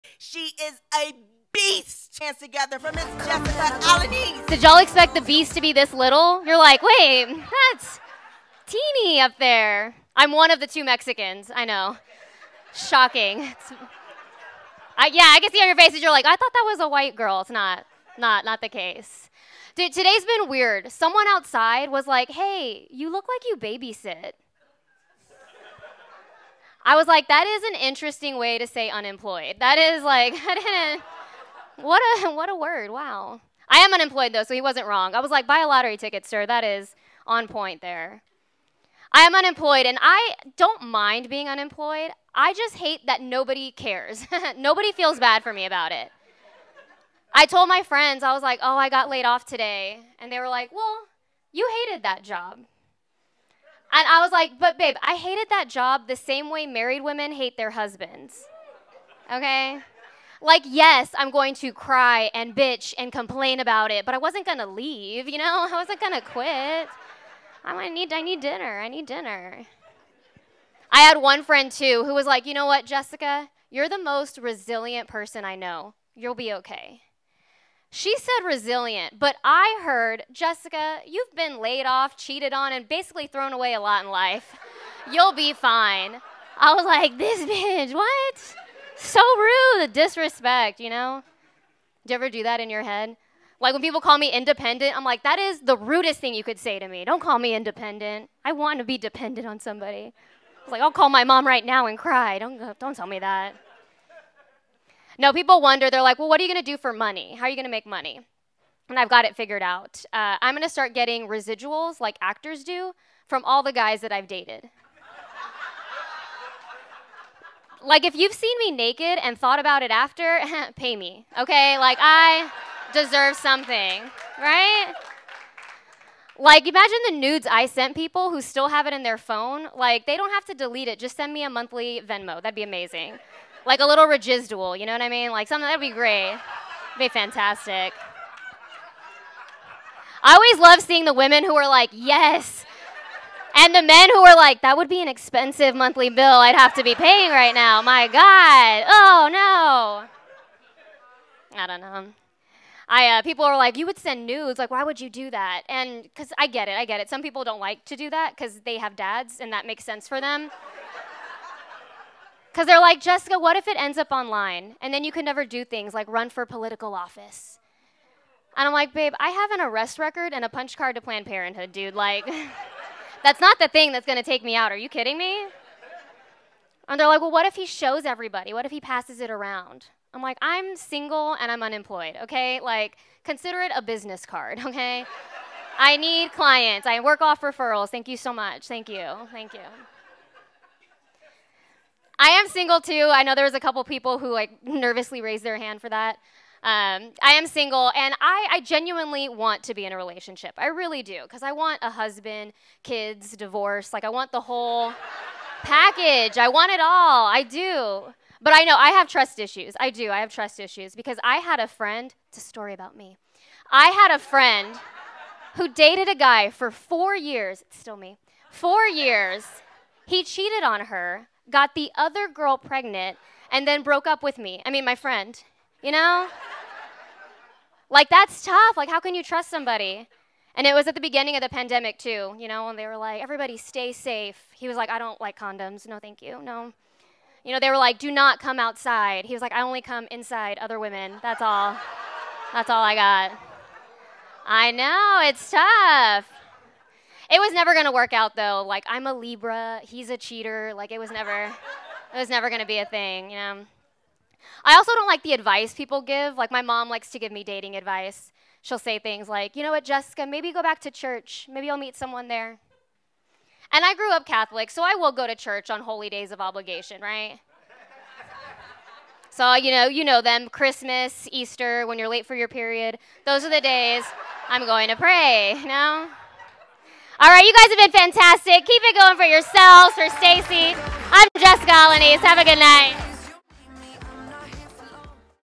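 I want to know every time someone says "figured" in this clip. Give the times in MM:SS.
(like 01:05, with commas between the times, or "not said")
01:49.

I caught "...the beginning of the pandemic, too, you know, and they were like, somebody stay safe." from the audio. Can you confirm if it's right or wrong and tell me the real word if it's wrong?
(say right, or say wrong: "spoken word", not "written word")
wrong: "everybody", not "somebody".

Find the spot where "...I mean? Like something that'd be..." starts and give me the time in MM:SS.
02:15.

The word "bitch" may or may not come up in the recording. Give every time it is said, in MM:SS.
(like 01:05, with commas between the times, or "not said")
01:02, 01:27.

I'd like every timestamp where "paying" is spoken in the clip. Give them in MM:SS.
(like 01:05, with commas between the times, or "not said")
02:26.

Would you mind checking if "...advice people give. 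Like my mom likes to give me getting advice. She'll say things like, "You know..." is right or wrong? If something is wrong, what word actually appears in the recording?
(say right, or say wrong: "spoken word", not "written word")
wrong: "dating", not "getting".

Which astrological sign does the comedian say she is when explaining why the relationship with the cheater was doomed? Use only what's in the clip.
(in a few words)
Libra.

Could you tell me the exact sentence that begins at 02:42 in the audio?
Because they're like, Jessica, what if it ends up online?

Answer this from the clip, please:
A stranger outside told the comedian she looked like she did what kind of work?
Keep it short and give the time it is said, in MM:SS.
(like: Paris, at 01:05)
Babysit, at 00:23.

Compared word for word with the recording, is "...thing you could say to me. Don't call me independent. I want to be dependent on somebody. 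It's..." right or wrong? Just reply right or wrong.
right.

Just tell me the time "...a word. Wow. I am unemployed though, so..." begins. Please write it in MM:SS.
00:32.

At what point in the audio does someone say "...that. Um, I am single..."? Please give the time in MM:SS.
03:15.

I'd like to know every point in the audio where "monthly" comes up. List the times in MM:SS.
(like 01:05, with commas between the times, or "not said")
02:11, 02:25.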